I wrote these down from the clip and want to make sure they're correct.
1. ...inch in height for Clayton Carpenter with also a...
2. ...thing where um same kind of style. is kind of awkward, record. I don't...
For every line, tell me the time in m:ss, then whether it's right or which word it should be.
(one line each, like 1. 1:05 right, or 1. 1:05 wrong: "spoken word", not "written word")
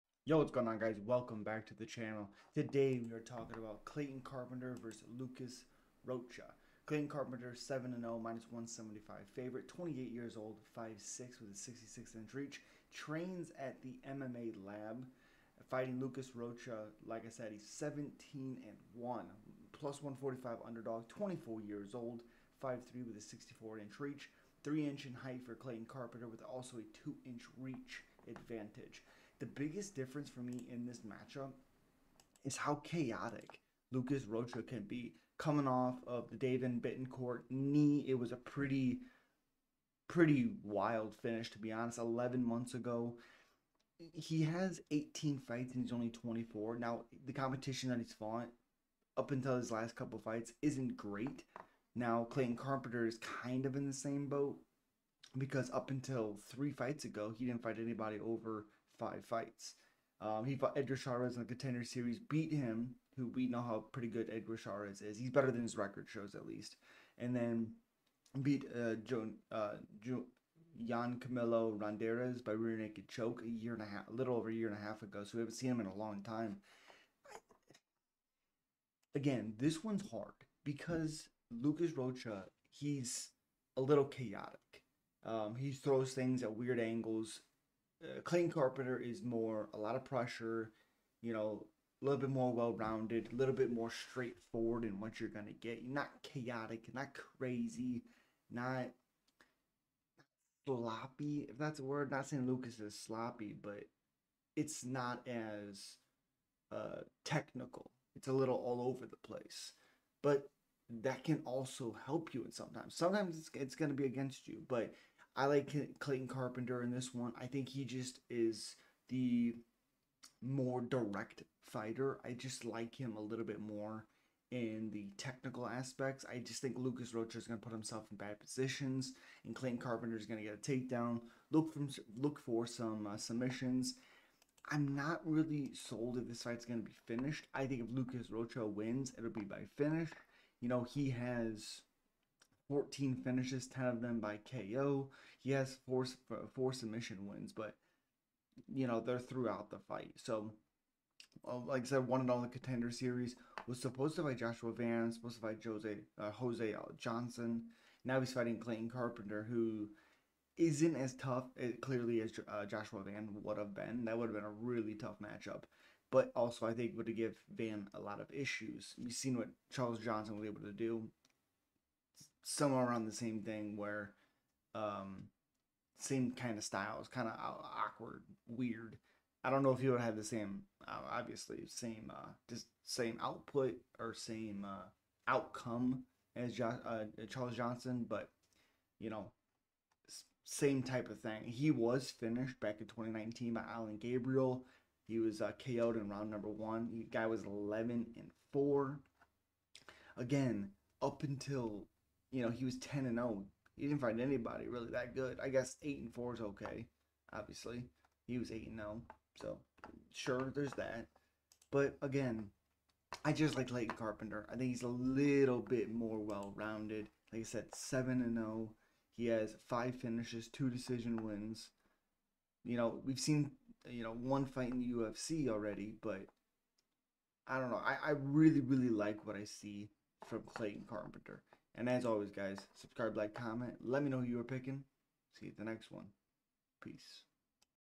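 1. 0:24 right
2. 2:53 wrong: "weird", not "record".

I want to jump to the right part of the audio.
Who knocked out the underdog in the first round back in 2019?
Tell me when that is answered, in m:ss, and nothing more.
3:13.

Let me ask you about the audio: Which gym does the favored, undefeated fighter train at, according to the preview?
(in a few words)
MMA Lab.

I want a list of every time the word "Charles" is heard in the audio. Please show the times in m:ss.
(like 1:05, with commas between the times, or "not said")
2:49, 3:07.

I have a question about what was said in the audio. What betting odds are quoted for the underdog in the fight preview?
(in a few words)
+145.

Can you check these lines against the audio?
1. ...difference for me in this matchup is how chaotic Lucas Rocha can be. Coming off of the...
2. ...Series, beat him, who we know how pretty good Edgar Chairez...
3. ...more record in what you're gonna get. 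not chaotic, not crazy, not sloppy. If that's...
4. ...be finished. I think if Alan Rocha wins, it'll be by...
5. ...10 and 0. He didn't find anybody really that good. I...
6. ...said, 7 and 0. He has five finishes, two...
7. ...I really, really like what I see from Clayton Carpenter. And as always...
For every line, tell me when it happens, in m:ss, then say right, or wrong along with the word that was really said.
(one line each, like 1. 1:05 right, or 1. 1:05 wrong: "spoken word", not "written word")
1. 0:29 right
2. 1:01 right
3. 1:33 wrong: "straightforward", not "record"
4. 2:16 wrong: "Lucas", not "Alan"
5. 3:22 right
6. 3:37 right
7. 3:48 right.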